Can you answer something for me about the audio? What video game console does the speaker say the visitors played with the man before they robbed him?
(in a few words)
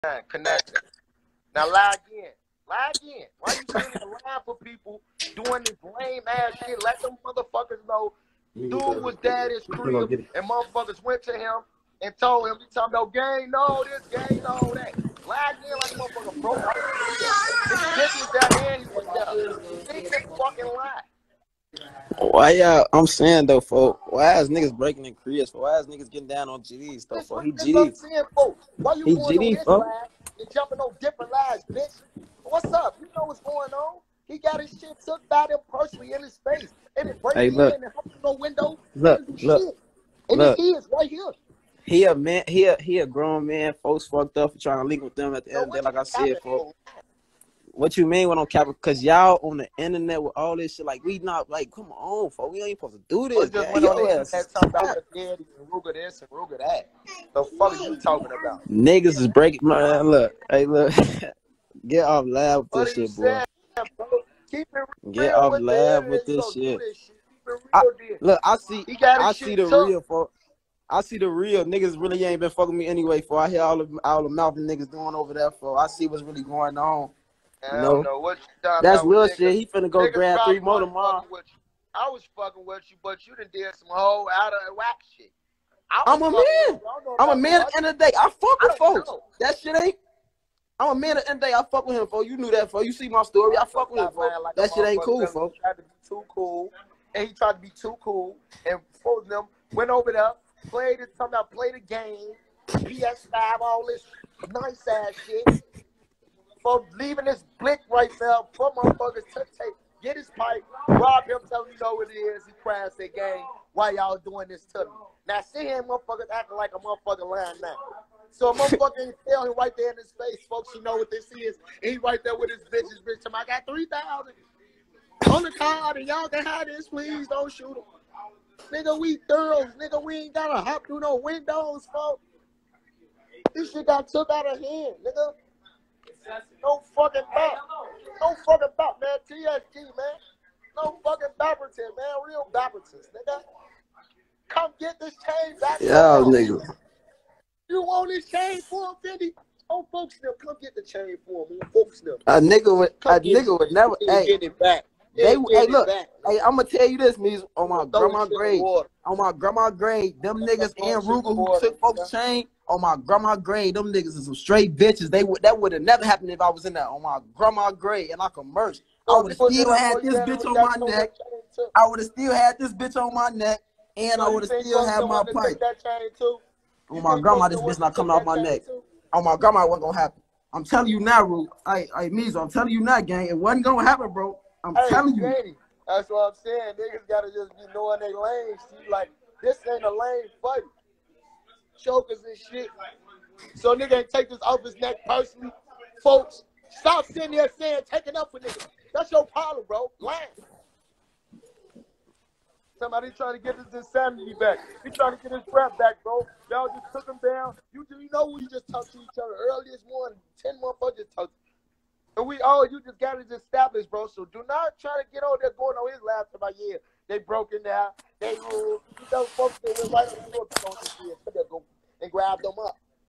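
PS5.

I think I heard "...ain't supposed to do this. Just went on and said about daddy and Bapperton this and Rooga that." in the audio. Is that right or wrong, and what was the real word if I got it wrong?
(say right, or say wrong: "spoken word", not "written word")
wrong: "Rooga", not "Bapperton".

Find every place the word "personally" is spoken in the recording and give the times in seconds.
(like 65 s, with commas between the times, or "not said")
35 s, 195 s.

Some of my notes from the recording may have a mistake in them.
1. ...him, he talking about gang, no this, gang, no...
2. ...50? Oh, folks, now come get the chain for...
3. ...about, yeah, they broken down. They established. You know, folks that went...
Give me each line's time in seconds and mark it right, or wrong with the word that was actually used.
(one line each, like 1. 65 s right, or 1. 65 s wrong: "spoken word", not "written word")
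1. 12 s right
2. 149 s right
3. 216 s wrong: "ruled", not "established".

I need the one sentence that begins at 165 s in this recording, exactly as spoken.
They would that would have never happened if I was in that on oh, my grandma grade and I could merch.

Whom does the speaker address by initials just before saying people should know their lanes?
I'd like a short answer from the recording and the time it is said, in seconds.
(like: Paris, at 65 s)
KD, at 185 s.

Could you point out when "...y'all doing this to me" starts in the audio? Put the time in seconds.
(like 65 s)
113 s.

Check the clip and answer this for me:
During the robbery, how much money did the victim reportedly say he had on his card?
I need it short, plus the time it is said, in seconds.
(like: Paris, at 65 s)
3000, at 123 s.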